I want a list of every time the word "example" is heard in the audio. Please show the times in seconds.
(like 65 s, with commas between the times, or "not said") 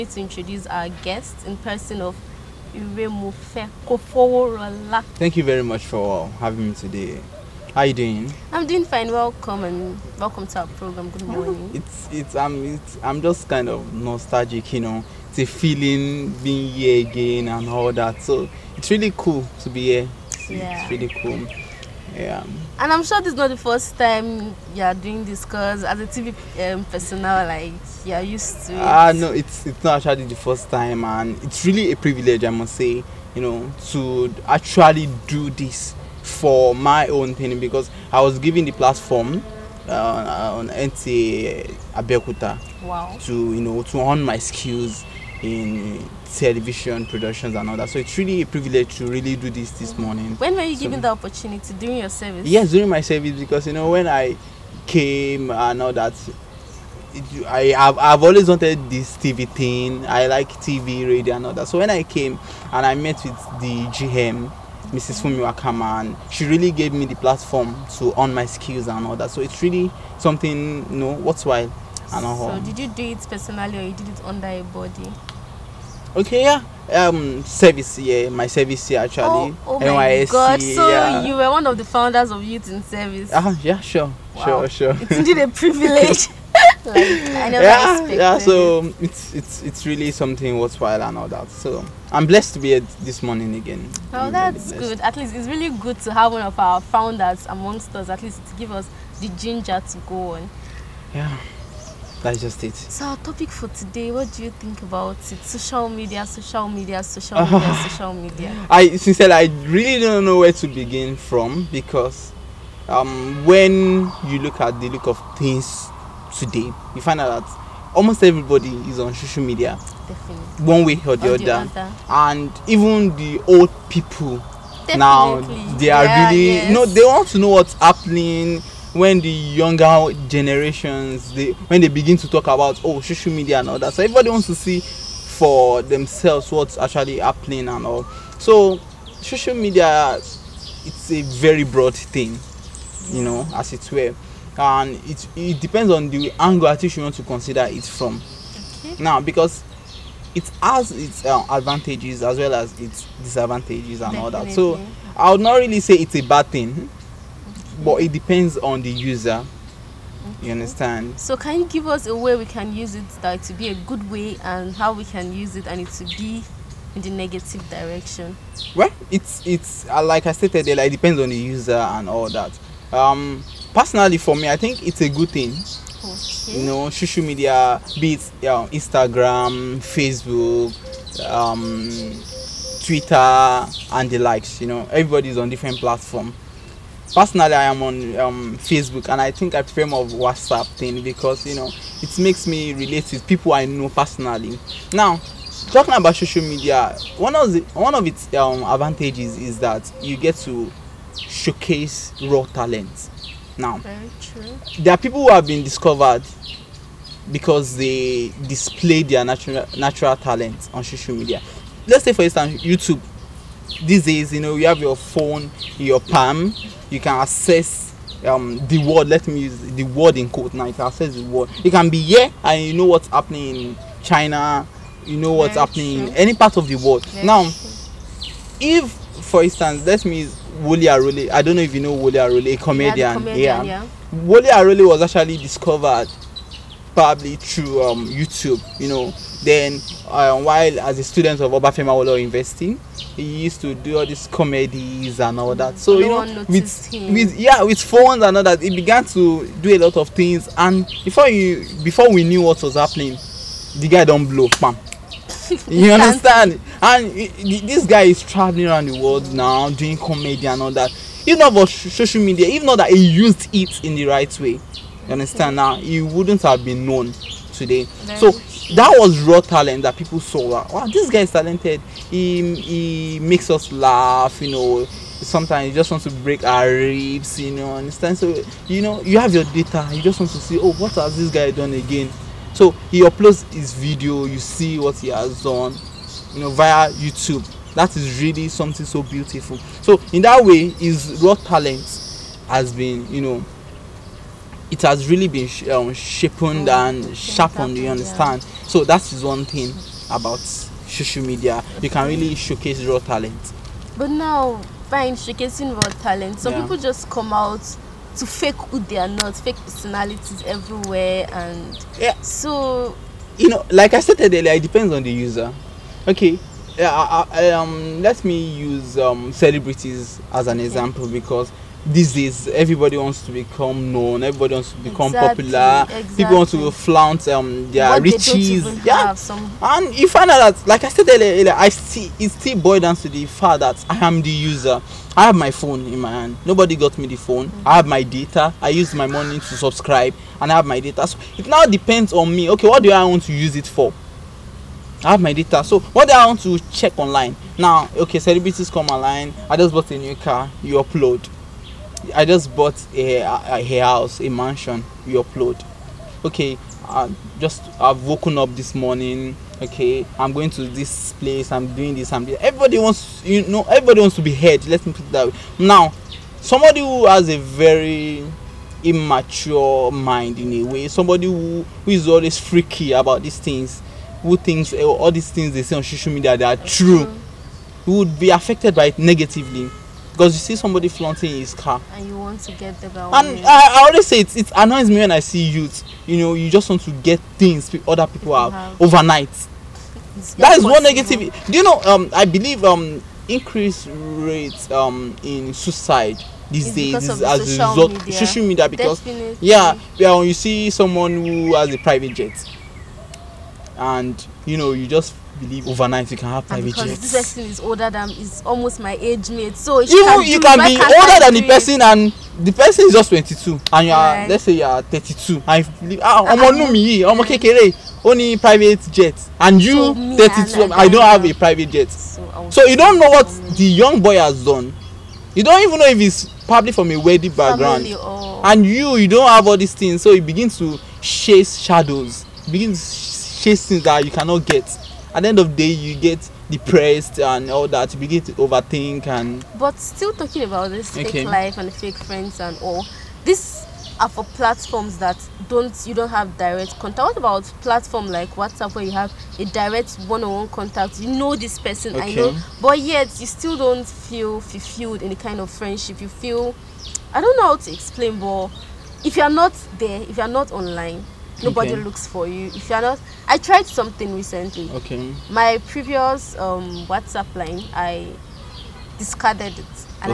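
320 s.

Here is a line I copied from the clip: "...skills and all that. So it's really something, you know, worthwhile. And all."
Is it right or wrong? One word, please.
right.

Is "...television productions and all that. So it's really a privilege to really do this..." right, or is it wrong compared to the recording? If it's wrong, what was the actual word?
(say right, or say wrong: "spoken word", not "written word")
right.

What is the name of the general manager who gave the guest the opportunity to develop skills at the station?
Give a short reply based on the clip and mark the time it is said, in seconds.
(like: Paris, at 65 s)
Mrs. Fumi Wakaman, at 64 s.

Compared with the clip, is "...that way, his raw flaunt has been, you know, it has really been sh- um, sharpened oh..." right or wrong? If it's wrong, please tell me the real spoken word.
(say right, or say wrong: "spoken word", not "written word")
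wrong: "talent", not "flaunt".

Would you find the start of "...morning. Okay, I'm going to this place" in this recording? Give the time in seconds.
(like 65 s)
358 s.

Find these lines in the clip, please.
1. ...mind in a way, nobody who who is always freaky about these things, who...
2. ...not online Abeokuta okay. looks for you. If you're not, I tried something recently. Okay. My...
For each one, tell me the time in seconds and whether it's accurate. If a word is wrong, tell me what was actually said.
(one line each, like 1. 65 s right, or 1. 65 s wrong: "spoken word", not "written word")
1. 369 s wrong: "somebody", not "nobody"
2. 460 s wrong: "Nobody", not "Abeokuta".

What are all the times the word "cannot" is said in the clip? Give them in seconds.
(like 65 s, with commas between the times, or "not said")
434 s.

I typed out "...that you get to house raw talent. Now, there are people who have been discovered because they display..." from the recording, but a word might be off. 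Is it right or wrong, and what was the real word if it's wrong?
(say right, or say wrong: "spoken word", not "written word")
wrong: "showcase", not "house".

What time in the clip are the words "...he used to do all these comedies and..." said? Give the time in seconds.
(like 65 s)
243 s.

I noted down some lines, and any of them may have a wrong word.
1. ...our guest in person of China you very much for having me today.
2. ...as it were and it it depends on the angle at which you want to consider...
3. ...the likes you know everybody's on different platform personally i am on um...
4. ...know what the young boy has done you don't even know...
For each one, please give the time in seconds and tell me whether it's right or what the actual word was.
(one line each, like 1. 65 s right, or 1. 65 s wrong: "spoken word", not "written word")
1. 0 s wrong: "Thank", not "China"
2. 143 s right
3. 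184 s right
4. 422 s right.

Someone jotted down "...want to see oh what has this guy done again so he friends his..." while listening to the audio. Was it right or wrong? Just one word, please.
wrong.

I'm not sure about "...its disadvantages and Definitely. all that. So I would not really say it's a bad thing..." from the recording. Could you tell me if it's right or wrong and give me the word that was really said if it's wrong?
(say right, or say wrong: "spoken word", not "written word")
right.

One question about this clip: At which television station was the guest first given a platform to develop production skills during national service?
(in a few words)
NTA Abeokuta.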